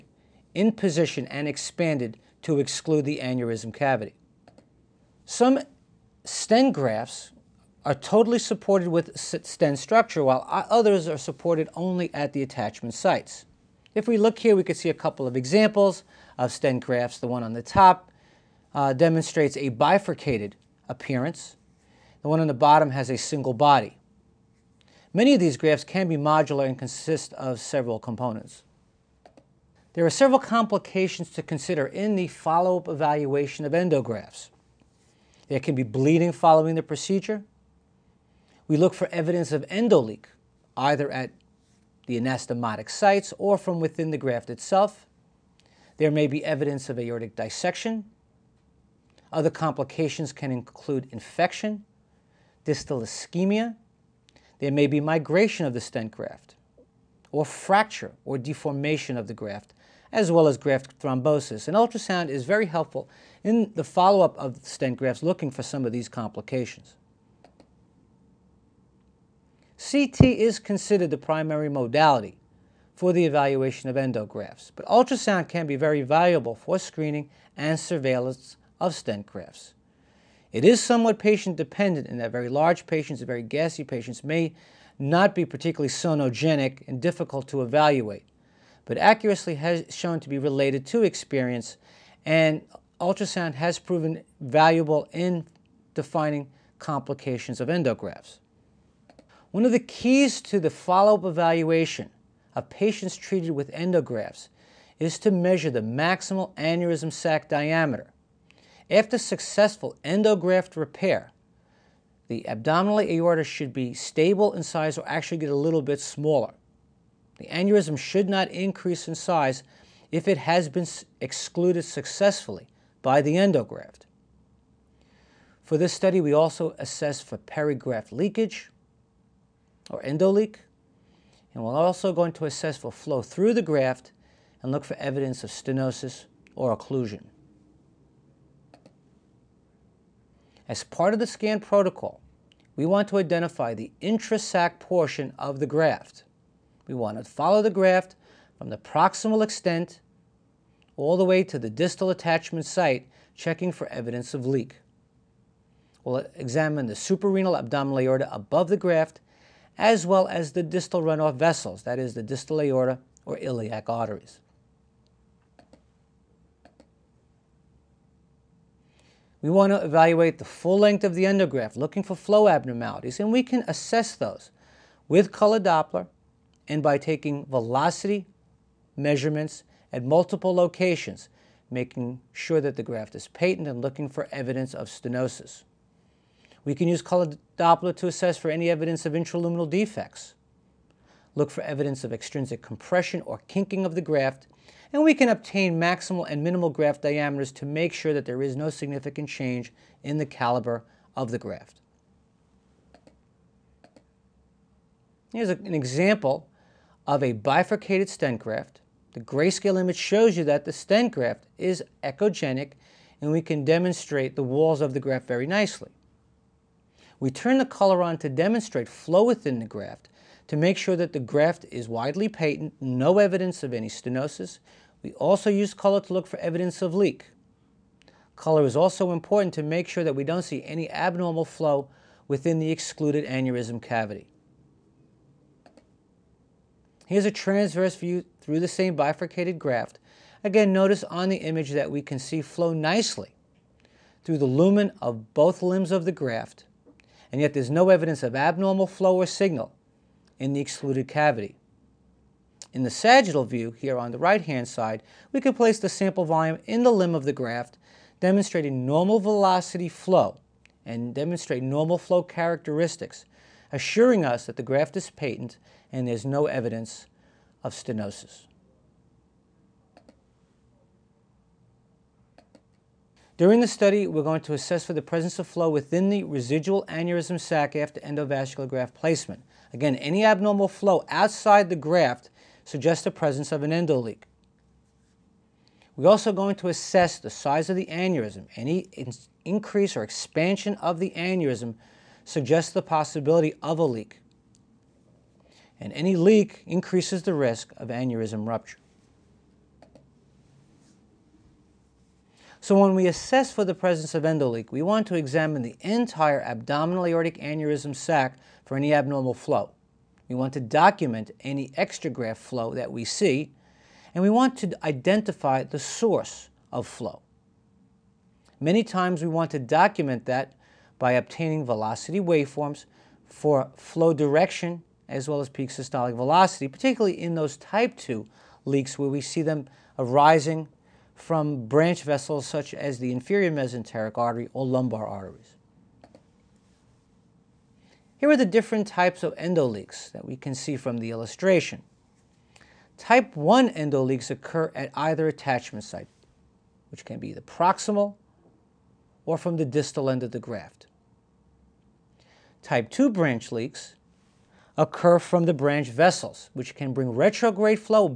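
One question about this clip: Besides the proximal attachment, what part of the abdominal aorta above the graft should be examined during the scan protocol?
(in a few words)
suprarenal abdominal aorta.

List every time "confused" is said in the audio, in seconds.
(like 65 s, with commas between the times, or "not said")
not said.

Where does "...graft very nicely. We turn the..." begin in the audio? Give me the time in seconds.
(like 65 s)
215 s.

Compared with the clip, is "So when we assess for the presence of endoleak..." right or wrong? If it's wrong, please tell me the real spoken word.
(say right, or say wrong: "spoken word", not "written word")
right.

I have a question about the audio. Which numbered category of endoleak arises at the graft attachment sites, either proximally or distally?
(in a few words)
Type 1.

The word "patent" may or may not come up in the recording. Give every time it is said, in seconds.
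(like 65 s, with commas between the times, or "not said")
183 s, 222 s, 265 s.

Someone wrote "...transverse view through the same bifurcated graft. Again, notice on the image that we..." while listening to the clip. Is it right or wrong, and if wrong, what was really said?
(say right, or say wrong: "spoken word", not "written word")
right.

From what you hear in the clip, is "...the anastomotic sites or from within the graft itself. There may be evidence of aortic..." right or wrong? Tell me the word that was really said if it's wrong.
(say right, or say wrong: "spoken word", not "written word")
right.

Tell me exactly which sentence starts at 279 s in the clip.
Again, any abnormal flow outside the graft suggests the presence of an endoleak.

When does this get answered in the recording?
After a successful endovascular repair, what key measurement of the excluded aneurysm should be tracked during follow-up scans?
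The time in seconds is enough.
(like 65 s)
105 s.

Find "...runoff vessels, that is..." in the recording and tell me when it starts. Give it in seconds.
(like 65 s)
161 s.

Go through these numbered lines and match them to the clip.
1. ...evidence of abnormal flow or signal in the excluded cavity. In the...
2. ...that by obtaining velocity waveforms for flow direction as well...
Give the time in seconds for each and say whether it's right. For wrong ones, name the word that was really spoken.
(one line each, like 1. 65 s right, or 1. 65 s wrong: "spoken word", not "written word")
1. 247 s right
2. 320 s right.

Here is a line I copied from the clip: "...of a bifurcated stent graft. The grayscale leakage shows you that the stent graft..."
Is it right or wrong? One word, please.
wrong.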